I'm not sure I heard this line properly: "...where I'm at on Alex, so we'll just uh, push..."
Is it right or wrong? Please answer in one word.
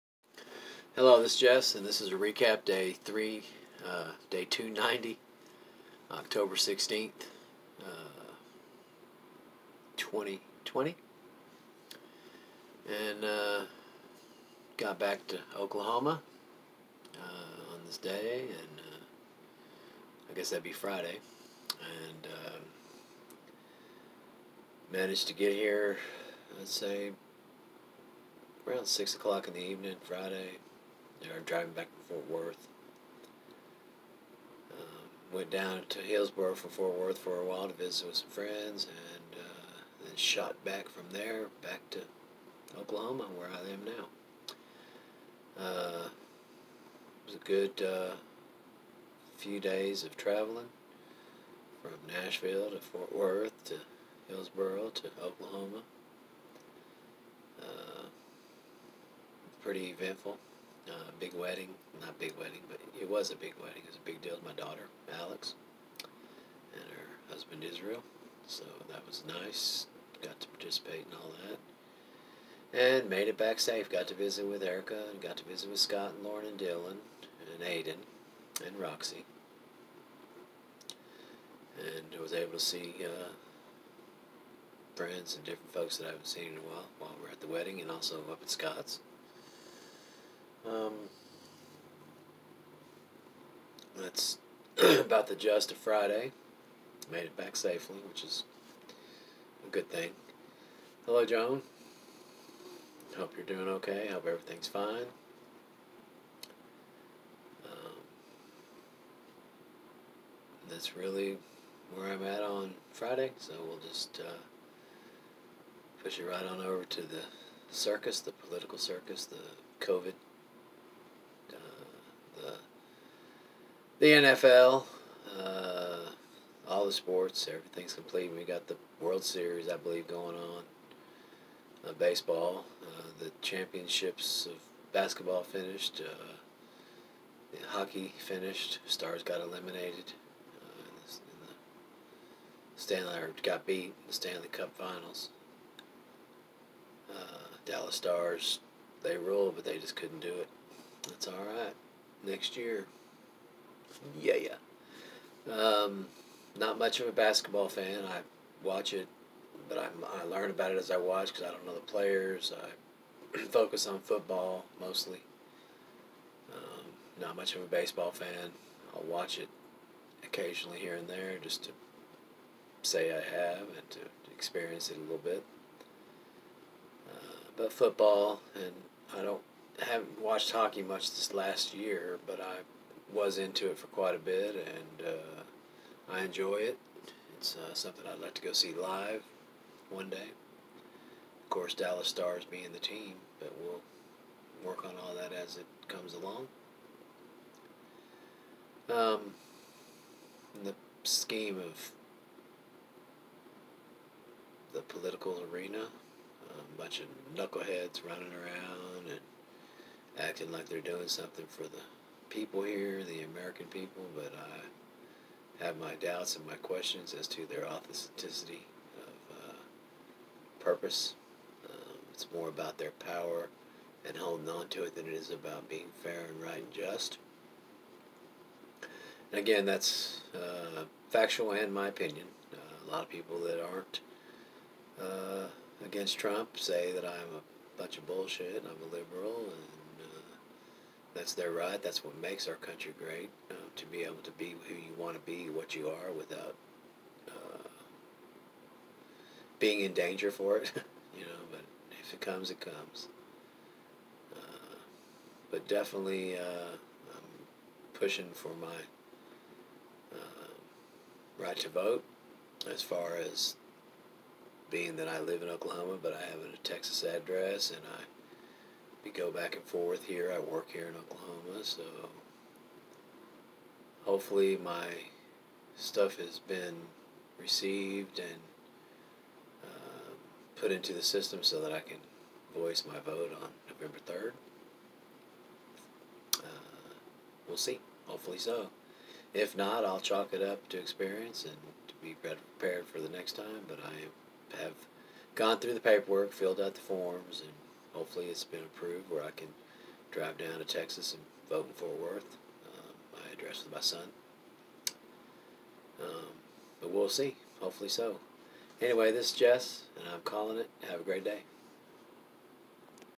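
wrong.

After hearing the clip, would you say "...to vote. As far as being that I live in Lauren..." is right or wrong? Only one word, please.
wrong.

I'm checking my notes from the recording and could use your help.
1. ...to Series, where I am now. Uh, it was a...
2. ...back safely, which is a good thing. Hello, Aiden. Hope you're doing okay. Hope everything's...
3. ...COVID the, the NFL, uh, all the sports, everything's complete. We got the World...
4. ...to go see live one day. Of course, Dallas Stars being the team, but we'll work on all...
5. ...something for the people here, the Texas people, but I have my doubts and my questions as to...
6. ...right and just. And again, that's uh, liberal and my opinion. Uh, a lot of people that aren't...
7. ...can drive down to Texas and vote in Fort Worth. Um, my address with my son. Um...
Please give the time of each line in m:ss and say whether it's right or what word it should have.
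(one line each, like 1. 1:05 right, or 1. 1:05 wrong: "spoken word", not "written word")
1. 0:41 wrong: "Oklahoma", not "Series"
2. 1:37 wrong: "Joan", not "Aiden"
3. 1:59 right
4. 3:08 right
5. 3:31 wrong: "American", not "Texas"
6. 3:46 wrong: "factual", not "liberal"
7. 4:59 right.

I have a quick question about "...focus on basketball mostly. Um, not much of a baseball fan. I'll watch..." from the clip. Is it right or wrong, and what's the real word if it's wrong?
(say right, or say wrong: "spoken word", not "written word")
wrong: "football", not "basketball".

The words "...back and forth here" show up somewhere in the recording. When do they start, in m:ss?
4:29.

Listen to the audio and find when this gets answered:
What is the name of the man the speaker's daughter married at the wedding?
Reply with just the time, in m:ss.
1:07.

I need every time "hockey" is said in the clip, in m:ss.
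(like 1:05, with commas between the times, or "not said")
2:17, 3:00.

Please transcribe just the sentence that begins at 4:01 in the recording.
That's what makes our country great.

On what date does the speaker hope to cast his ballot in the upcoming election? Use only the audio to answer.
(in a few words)
November 3rd.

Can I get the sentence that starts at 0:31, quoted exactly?
They were driving back from Fort Worth.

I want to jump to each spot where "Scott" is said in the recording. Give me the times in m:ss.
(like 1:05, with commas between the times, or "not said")
1:15, 1:28.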